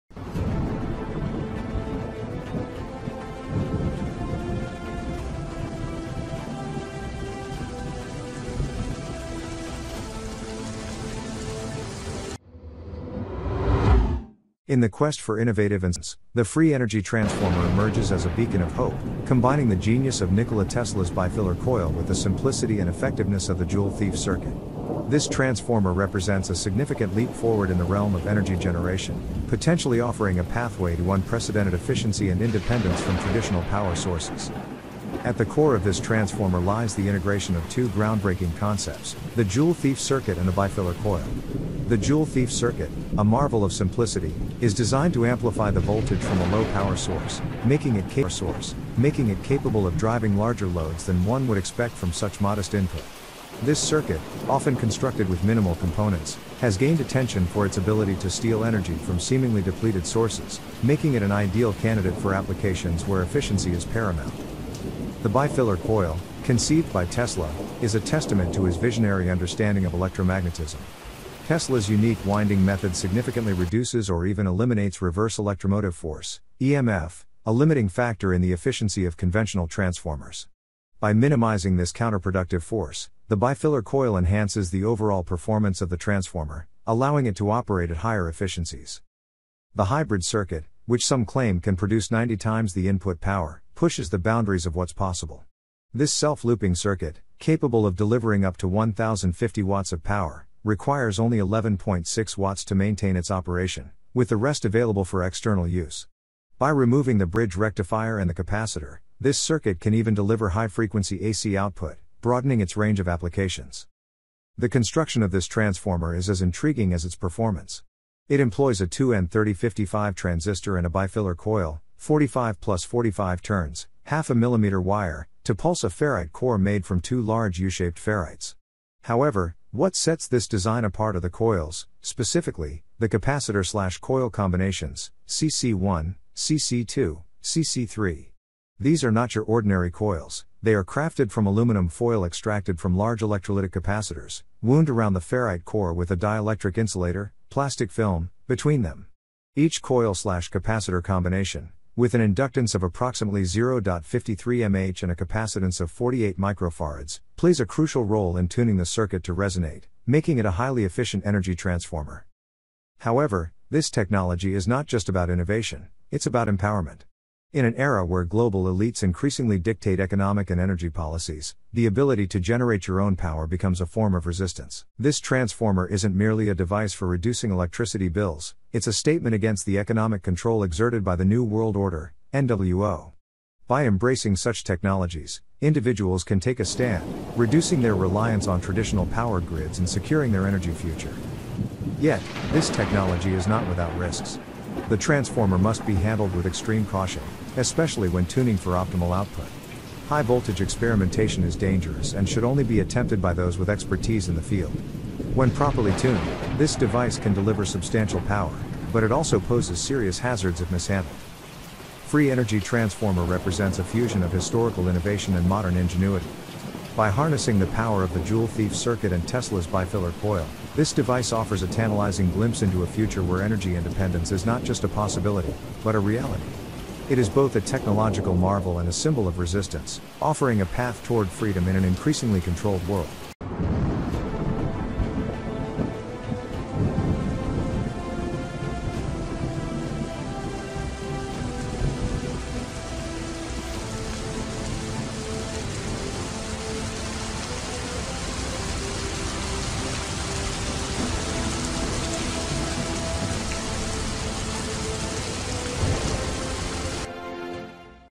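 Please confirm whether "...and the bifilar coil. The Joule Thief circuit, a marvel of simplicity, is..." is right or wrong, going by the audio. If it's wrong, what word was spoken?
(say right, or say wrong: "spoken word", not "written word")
right.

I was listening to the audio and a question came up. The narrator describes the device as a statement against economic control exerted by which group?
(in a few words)
New World Order.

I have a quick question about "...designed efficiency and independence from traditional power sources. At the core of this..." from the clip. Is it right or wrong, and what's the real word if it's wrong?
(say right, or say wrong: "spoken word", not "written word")
wrong: "unprecedented", not "designed".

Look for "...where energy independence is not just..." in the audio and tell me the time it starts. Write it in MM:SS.
03:43.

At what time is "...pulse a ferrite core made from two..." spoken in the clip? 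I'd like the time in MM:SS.
02:05.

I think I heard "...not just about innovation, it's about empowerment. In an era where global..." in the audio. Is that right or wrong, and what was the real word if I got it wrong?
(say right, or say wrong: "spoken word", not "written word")
right.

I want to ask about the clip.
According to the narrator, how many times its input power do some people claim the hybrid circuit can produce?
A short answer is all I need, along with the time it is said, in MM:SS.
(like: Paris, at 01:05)
90 times, at 01:32.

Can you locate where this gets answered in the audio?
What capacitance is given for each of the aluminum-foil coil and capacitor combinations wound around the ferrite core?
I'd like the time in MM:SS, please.
02:35.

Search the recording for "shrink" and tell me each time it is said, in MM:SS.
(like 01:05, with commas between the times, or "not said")
not said.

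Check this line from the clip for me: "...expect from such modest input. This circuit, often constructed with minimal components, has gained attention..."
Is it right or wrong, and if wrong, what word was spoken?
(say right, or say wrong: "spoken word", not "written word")
right.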